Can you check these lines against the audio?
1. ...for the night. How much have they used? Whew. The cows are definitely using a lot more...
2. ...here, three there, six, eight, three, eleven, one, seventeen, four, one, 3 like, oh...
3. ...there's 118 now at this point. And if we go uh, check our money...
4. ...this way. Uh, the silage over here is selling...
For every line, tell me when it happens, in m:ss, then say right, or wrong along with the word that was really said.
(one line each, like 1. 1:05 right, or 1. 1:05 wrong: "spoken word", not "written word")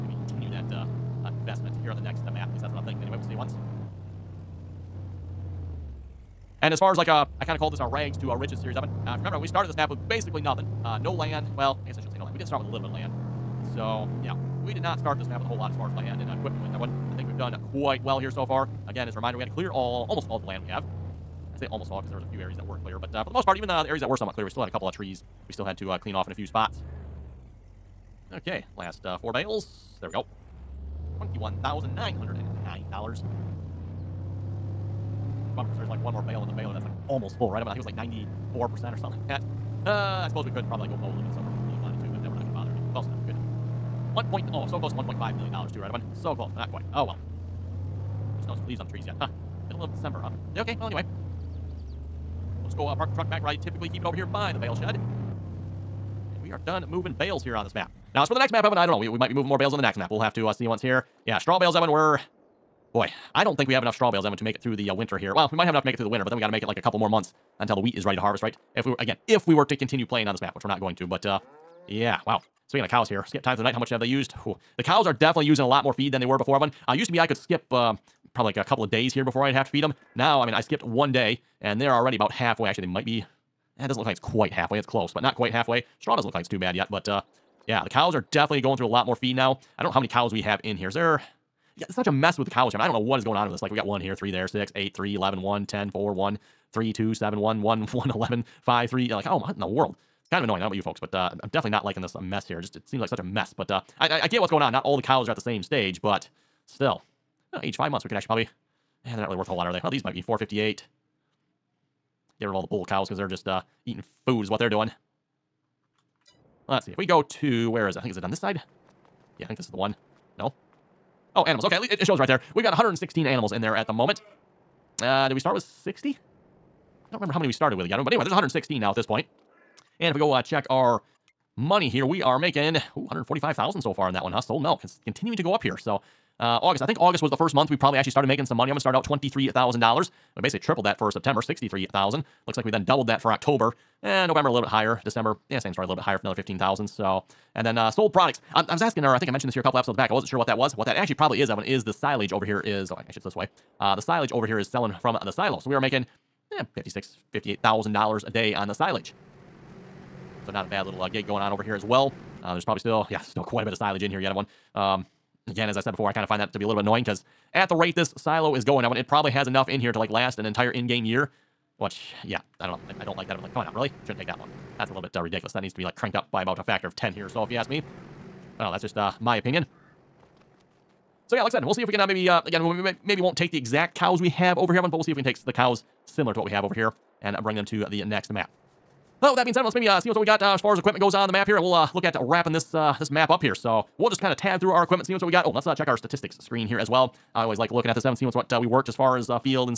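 1. 1:13 right
2. 1:34 wrong: "ten", not "seventeen"
3. 2:08 wrong: "116", not "118"
4. 2:33 right.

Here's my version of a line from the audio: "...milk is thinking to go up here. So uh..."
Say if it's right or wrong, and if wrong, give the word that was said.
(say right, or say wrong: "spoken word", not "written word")
wrong: "continuing", not "thinking".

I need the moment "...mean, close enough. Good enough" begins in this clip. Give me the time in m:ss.
0:42.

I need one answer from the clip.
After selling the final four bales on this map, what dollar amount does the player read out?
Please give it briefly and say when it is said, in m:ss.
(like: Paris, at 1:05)
$21,909, at 0:31.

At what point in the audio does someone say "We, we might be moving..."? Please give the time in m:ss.
0:58.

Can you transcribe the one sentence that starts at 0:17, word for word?
I think we've done quite well here so far.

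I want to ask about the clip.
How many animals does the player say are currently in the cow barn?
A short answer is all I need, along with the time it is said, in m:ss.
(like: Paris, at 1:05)
116, at 2:02.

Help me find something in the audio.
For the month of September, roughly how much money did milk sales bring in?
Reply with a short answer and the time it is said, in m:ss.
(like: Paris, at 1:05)
63,000, at 2:21.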